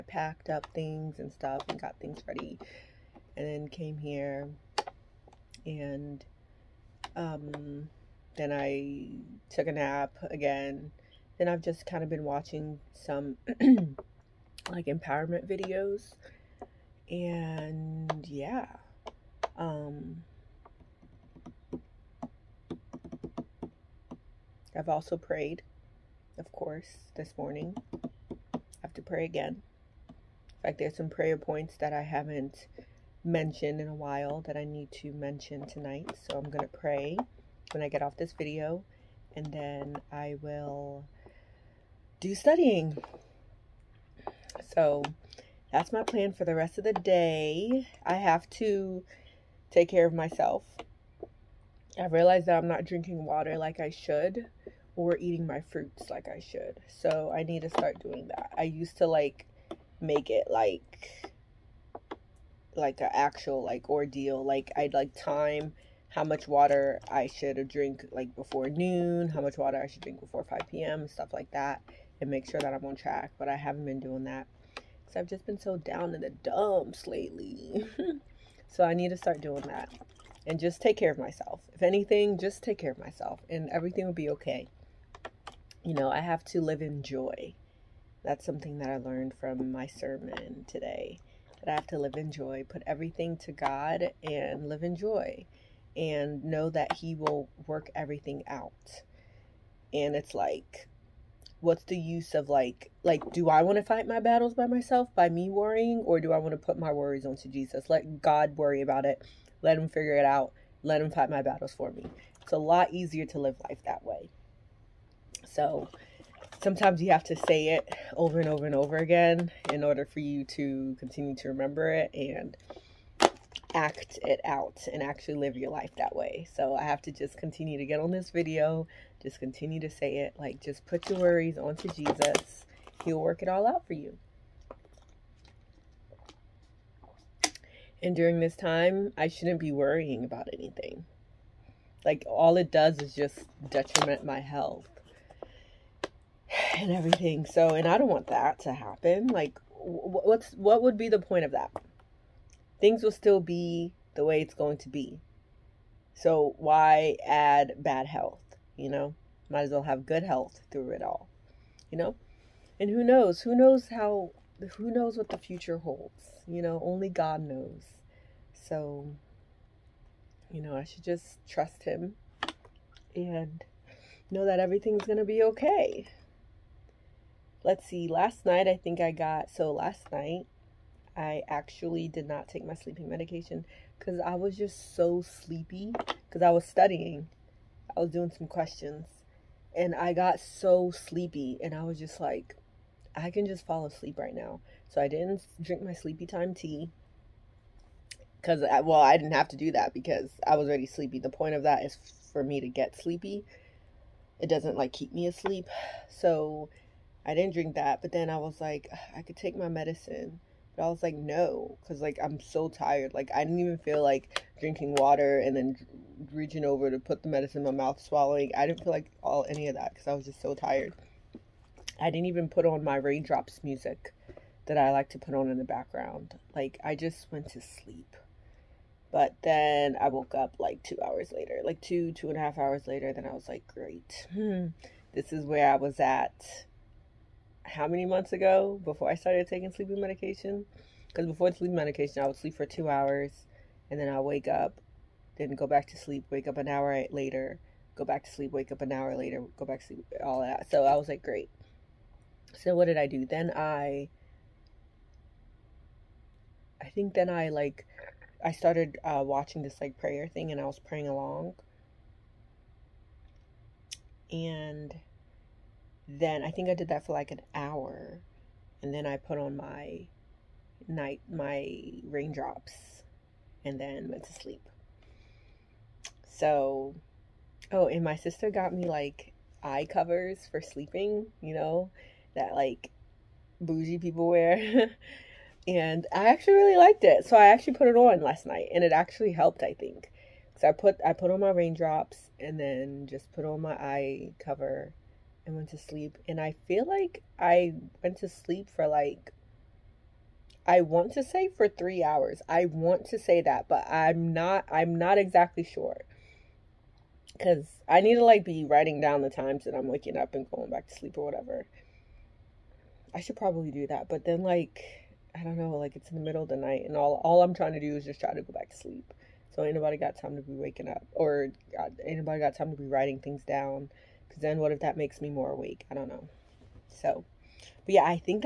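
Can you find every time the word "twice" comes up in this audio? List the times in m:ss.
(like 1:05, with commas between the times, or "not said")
not said.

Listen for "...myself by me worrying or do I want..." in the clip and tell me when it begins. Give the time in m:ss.
1:44.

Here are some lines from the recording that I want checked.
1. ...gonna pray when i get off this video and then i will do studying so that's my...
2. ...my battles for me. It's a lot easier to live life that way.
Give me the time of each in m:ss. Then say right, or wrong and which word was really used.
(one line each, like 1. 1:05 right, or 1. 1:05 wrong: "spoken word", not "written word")
1. 0:36 right
2. 1:51 right.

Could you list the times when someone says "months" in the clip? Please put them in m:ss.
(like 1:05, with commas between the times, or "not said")
3:58.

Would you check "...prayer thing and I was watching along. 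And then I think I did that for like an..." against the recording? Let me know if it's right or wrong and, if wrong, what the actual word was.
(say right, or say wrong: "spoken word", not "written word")
wrong: "praying", not "watching".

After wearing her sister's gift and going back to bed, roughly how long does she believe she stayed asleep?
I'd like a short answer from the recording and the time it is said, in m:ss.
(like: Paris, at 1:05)
3 hours, at 5:01.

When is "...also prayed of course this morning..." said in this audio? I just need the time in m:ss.
0:24.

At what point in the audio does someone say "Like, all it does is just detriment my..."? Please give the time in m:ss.
2:22.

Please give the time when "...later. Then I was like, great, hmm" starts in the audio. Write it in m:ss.
3:52.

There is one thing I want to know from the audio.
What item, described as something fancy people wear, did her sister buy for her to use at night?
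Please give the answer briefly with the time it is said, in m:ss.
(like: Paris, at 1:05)
eye covers, at 4:39.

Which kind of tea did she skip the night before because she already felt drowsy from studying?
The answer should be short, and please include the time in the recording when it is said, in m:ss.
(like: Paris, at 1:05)
sleepy time tea, at 3:15.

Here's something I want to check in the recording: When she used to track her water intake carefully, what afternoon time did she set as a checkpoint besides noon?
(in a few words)
5 p.m.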